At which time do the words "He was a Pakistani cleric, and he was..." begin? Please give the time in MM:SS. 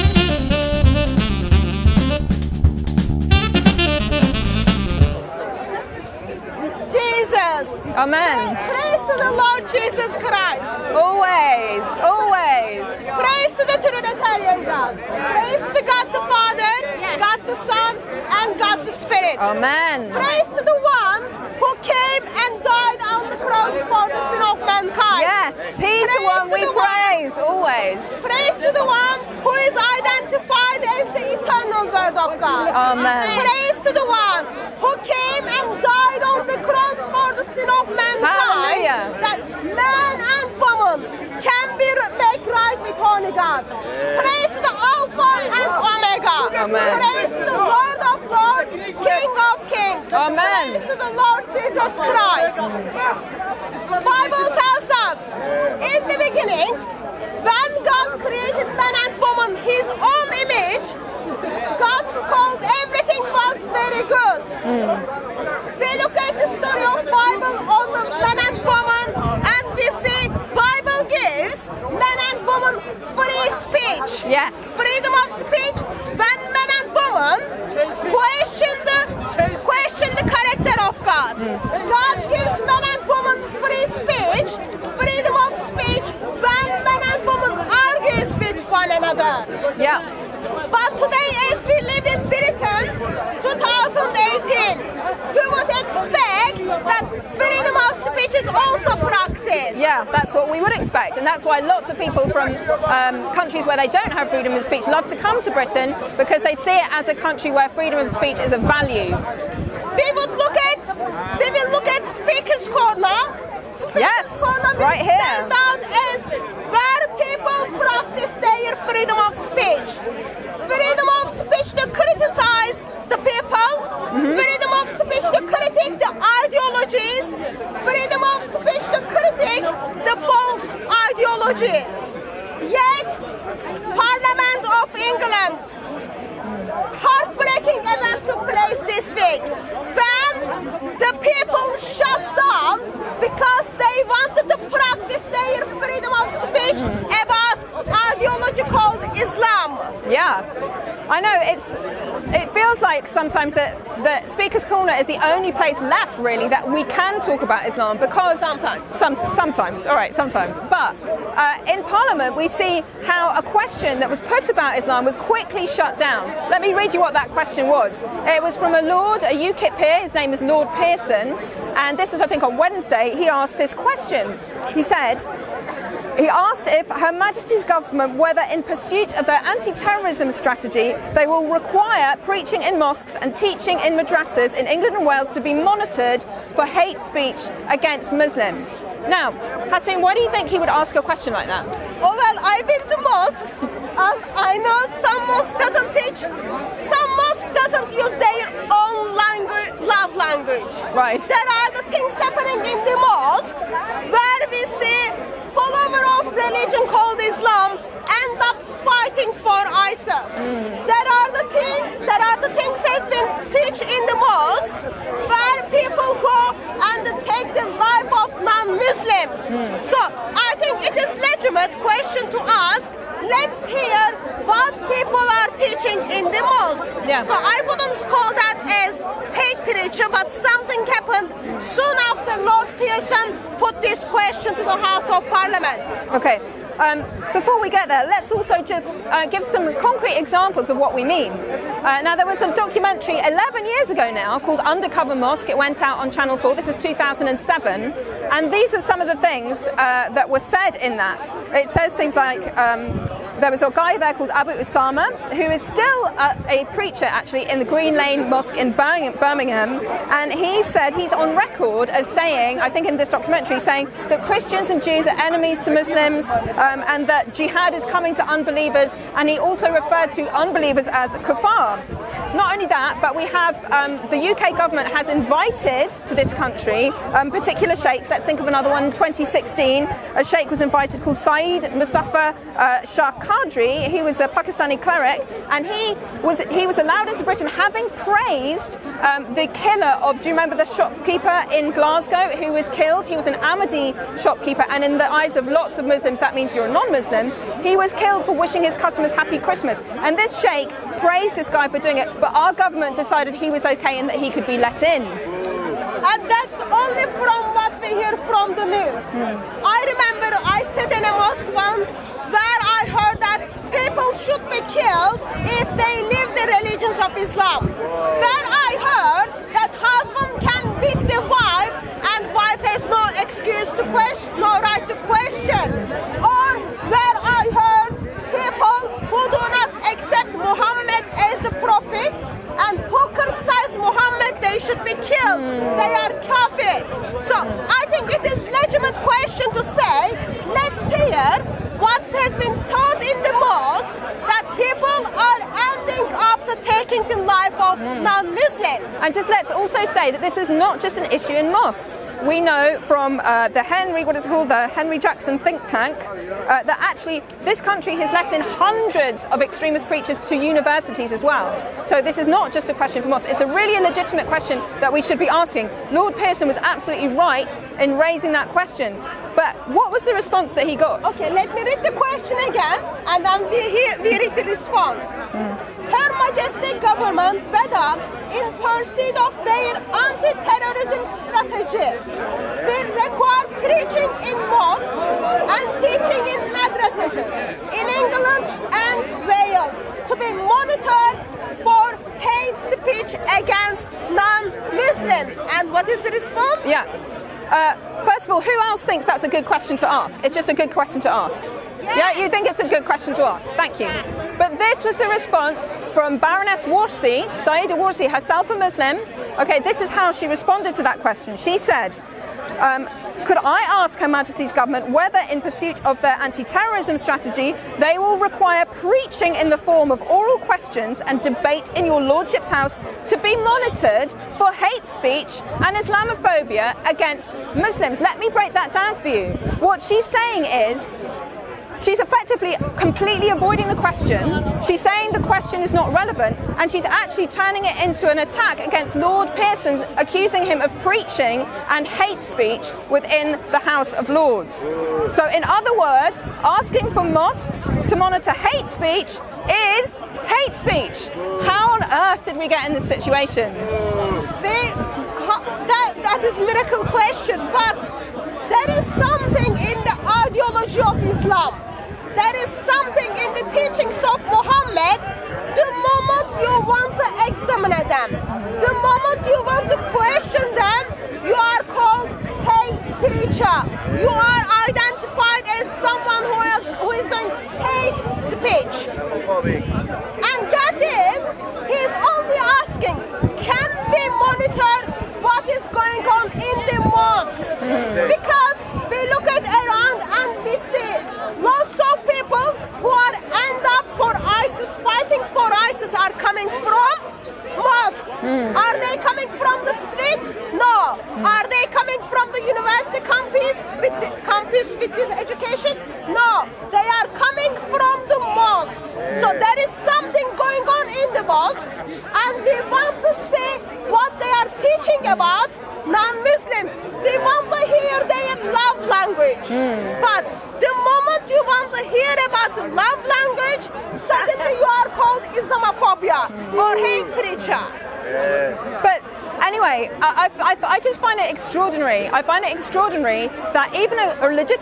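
04:43.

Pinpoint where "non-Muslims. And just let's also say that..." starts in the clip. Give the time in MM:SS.
05:48.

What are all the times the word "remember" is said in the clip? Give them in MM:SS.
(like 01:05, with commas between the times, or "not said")
04:50, 05:09.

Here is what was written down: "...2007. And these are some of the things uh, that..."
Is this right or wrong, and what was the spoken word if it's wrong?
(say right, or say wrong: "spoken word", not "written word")
right.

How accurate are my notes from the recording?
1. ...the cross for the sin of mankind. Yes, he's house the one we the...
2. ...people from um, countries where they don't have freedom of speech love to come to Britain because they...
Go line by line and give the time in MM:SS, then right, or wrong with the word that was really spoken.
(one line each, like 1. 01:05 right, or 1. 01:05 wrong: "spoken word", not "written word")
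1. 00:23 wrong: "praise", not "house"
2. 01:41 right.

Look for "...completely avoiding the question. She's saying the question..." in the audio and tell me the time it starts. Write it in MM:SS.
07:12.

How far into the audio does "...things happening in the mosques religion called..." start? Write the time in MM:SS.
03:21.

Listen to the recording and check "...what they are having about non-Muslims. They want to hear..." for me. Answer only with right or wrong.
wrong.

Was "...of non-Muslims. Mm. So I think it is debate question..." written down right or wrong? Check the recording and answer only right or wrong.
wrong.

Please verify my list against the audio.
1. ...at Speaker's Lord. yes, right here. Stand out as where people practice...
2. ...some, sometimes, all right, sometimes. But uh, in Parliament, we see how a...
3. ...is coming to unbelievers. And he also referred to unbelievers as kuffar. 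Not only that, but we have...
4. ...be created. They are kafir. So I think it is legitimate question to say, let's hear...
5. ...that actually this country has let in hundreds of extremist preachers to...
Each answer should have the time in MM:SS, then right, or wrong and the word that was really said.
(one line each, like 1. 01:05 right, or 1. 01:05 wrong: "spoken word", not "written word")
1. 01:51 wrong: "Corner", not "Lord"
2. 02:38 right
3. 04:27 right
4. 05:34 wrong: "killed", not "created"
5. 05:56 right.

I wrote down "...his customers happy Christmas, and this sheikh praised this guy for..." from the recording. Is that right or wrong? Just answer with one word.
right.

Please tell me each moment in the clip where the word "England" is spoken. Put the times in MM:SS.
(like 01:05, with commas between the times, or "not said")
02:15, 03:04, 06:27.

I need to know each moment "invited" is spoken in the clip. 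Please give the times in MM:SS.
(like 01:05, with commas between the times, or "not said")
04:35, 04:40.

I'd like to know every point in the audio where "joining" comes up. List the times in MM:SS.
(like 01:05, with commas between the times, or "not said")
not said.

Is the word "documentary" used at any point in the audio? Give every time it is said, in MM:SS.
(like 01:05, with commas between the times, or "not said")
04:02, 04:23.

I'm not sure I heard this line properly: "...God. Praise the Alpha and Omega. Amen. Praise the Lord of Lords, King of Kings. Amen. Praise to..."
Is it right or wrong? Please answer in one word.
right.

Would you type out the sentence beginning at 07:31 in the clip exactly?
How on earth did we get in this situation?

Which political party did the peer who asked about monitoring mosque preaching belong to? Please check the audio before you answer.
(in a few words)
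UKIP.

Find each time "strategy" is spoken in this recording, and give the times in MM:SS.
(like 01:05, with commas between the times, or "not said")
03:00, 06:21, 06:56.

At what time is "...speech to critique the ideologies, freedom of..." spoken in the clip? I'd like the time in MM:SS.
02:05.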